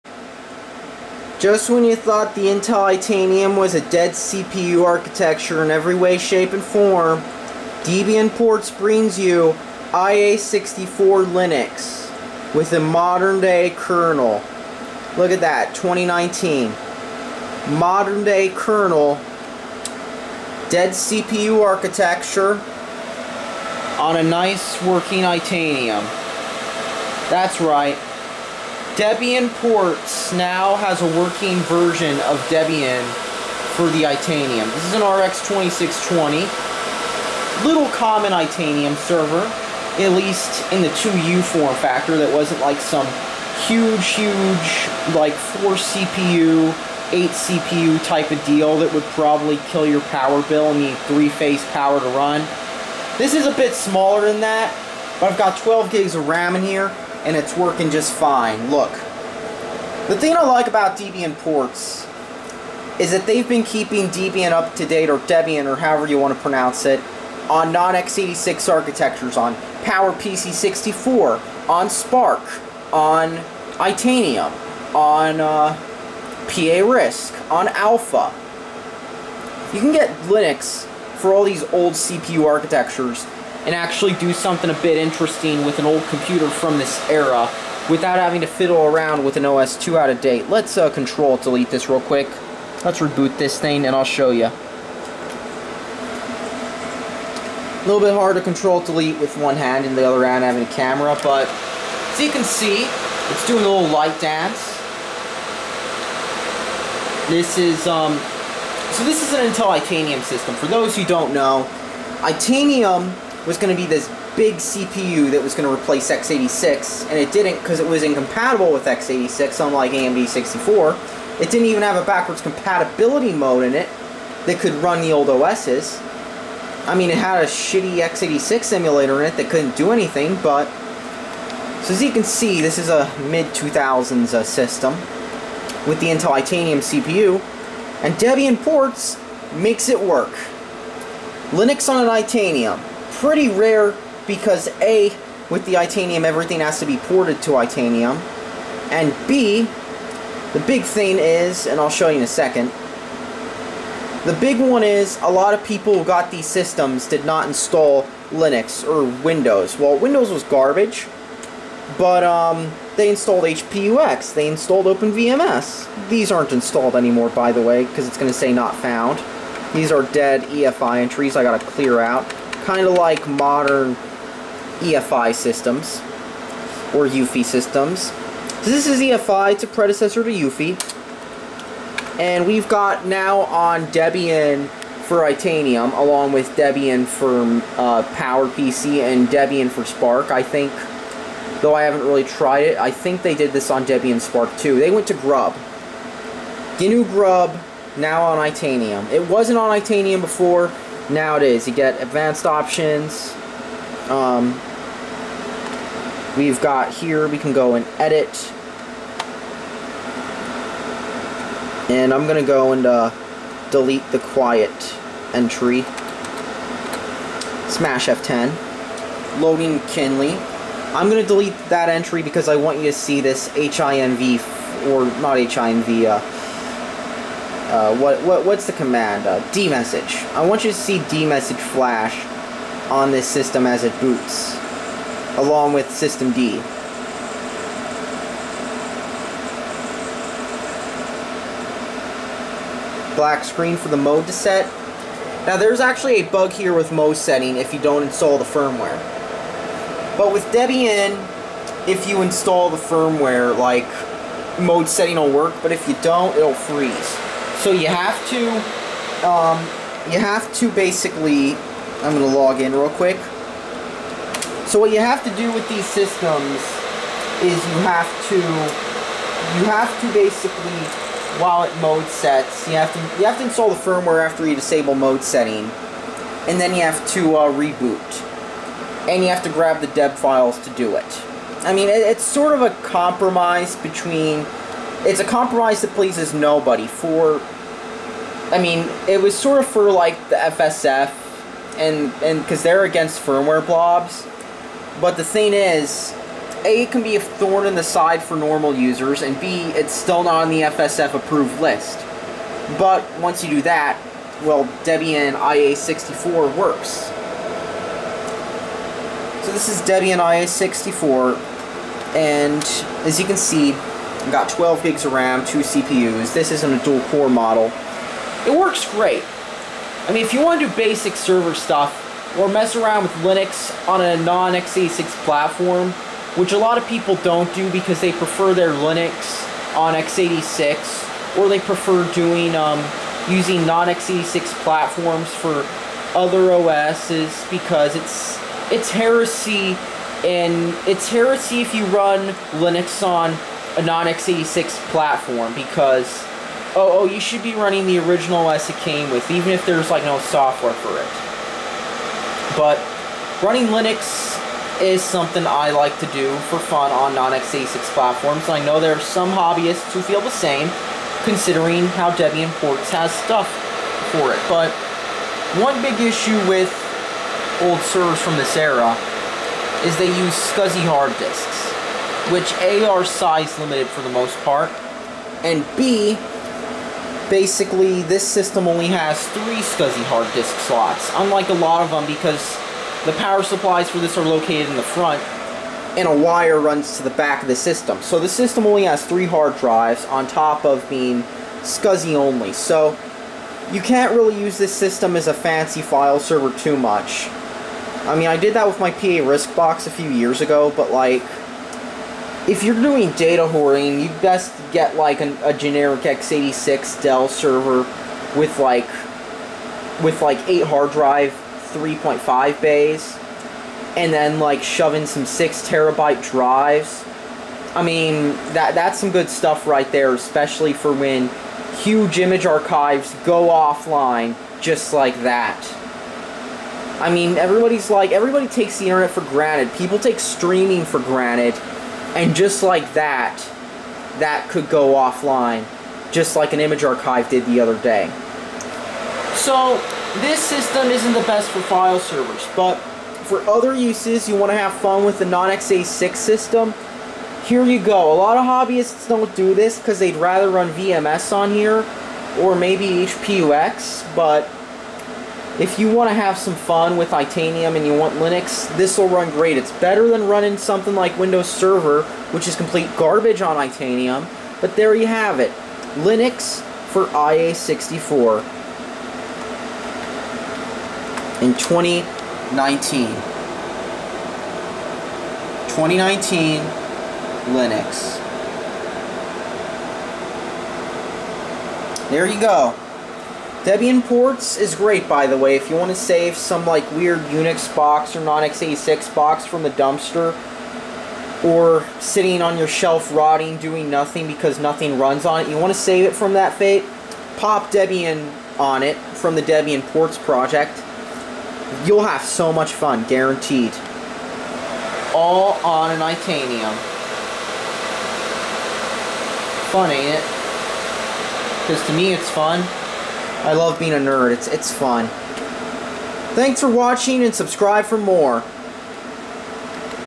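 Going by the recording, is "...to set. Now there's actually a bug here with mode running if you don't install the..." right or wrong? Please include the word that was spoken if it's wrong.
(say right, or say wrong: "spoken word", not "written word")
wrong: "setting", not "running".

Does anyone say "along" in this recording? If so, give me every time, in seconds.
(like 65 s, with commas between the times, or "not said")
185 s, 235 s.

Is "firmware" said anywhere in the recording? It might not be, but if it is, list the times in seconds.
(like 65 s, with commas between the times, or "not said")
248 s, 252 s, 273 s, 293 s.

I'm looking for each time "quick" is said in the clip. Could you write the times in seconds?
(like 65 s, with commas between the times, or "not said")
92 s, 262 s.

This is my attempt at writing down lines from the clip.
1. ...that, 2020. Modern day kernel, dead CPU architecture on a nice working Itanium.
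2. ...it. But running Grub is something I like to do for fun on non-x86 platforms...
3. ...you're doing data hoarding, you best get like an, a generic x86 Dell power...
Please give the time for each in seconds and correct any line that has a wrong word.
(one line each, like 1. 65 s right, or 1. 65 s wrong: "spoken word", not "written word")
1. 15 s wrong: "2019", not "2020"
2. 350 s wrong: "Linux", not "Grub"
3. 402 s wrong: "server", not "power".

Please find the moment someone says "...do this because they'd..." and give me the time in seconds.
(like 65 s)
449 s.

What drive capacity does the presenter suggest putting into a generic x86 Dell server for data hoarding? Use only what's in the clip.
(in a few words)
6 terabytes.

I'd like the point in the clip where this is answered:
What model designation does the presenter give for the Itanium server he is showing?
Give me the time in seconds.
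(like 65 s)
35 s.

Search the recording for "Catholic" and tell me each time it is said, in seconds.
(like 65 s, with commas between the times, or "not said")
not said.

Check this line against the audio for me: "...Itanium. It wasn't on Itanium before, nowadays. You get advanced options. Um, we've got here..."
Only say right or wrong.
right.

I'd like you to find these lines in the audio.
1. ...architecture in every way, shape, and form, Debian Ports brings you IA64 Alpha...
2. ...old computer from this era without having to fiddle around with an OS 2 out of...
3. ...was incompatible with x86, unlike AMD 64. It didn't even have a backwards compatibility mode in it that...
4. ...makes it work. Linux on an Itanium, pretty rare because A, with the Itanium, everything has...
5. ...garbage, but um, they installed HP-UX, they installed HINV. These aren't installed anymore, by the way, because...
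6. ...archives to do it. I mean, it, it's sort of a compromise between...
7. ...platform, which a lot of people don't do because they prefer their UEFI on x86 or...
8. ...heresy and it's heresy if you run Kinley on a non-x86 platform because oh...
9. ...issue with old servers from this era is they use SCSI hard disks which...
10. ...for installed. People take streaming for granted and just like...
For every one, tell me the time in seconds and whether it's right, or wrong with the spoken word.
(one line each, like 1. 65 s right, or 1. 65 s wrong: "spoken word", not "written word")
1. 4 s wrong: "Linux", not "Alpha"
2. 85 s right
3. 117 s right
4. 139 s right
5. 160 s wrong: "OpenVMS", not "HINV"
6. 280 s wrong: "files", not "archives"
7. 325 s wrong: "Linux", not "UEFI"
8. 338 s wrong: "Linux", not "Kinley"
9. 366 s right
10. 429 s wrong: "granted", not "installed".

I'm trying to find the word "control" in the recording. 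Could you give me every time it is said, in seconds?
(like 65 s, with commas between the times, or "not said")
90 s, 98 s.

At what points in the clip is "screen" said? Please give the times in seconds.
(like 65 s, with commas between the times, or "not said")
243 s.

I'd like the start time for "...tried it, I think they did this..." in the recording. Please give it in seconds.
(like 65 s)
192 s.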